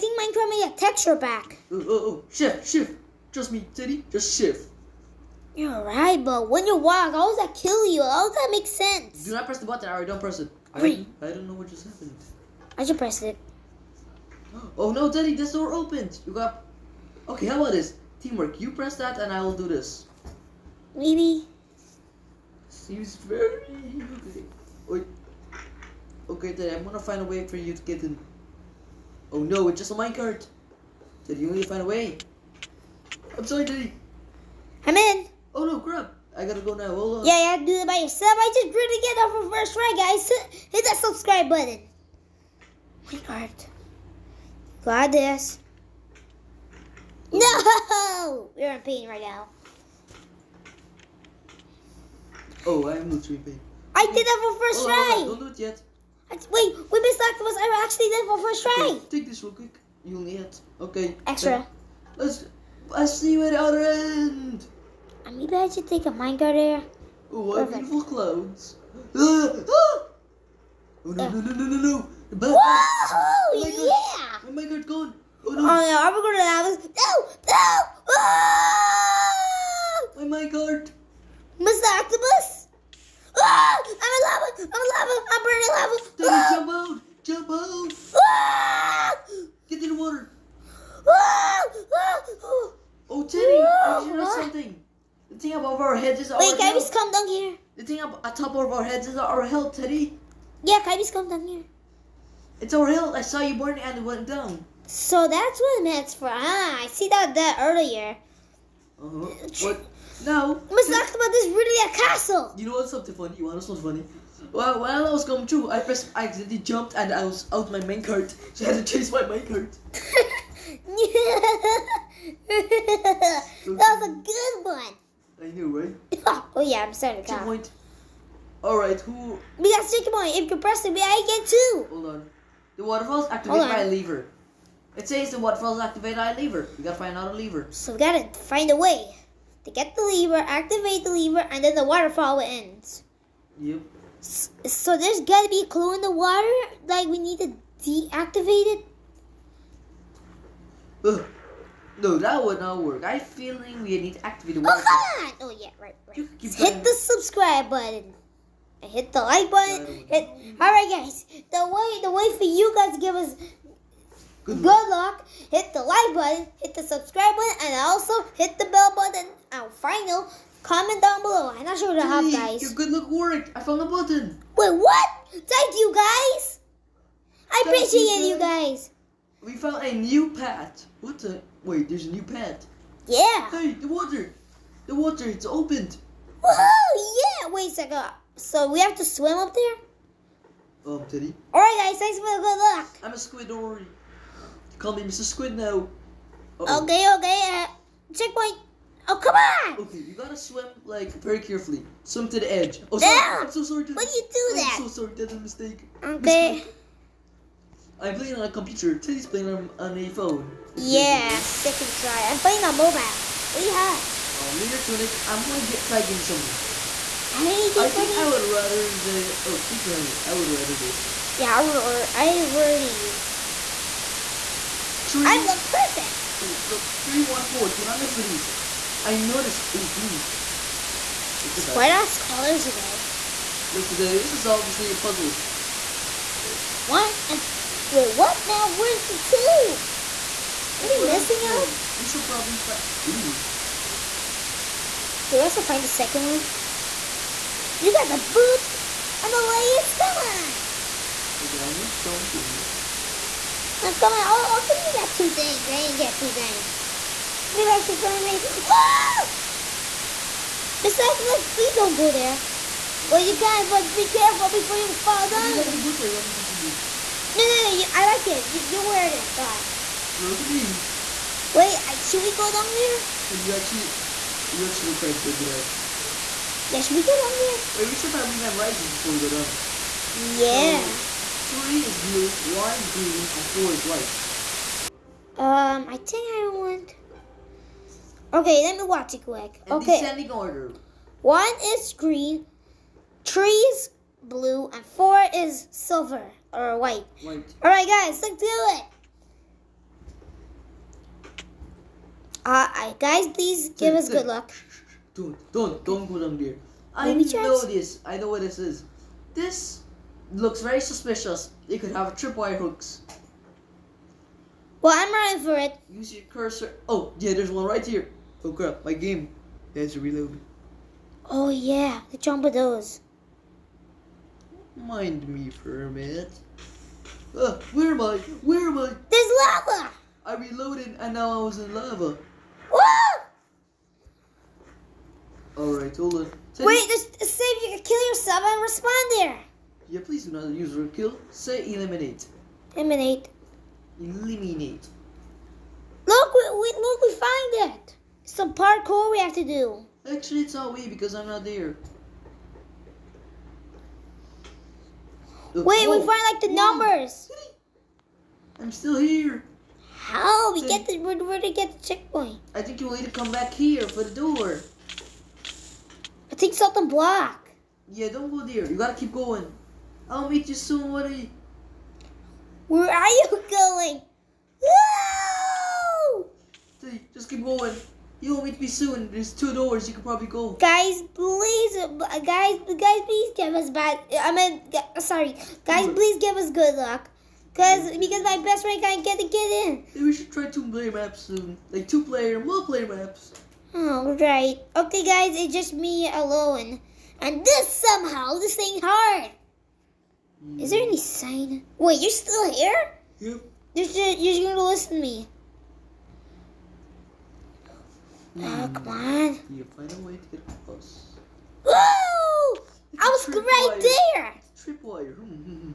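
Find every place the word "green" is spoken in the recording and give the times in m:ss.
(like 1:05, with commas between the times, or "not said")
4:42, 4:51.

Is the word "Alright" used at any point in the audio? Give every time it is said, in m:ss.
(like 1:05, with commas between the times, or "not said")
3:11, 5:35.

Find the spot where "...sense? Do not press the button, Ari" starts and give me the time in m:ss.
0:08.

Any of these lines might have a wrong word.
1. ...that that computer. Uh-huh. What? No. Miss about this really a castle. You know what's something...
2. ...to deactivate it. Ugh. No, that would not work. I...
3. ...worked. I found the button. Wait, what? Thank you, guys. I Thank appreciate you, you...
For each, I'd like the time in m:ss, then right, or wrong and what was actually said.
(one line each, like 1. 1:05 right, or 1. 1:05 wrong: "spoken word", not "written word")
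1. 1:47 wrong: "earlier", not "computer"
2. 2:27 right
3. 2:53 right.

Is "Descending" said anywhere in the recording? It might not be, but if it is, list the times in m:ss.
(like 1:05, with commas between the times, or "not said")
4:50.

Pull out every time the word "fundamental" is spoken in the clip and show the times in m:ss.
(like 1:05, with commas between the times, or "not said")
not said.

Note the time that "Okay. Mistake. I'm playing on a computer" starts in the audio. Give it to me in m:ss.
3:26.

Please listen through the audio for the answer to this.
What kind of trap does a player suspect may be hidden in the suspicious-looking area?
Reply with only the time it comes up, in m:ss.
5:11.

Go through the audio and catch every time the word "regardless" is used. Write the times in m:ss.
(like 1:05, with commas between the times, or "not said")
not said.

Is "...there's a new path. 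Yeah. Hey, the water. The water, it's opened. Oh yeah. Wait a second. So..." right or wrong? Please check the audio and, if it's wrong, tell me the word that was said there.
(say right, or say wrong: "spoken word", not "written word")
right.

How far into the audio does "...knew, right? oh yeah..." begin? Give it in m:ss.
2:05.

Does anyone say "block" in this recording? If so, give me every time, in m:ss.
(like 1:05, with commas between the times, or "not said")
6:06.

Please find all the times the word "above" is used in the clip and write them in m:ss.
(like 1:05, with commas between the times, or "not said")
1:35.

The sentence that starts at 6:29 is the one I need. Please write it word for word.
Maybe we should try two player maps soon, like two player, multiplayer maps.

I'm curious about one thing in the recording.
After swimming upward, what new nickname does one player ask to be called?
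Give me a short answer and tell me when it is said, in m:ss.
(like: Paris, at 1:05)
Mr. Squid, at 3:14.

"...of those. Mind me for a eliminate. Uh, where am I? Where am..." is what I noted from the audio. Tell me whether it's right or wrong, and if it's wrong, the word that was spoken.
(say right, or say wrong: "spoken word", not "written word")
wrong: "minute", not "eliminate".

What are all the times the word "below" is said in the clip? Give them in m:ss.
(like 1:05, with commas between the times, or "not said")
2:51.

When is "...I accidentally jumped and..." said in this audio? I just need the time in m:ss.
1:56.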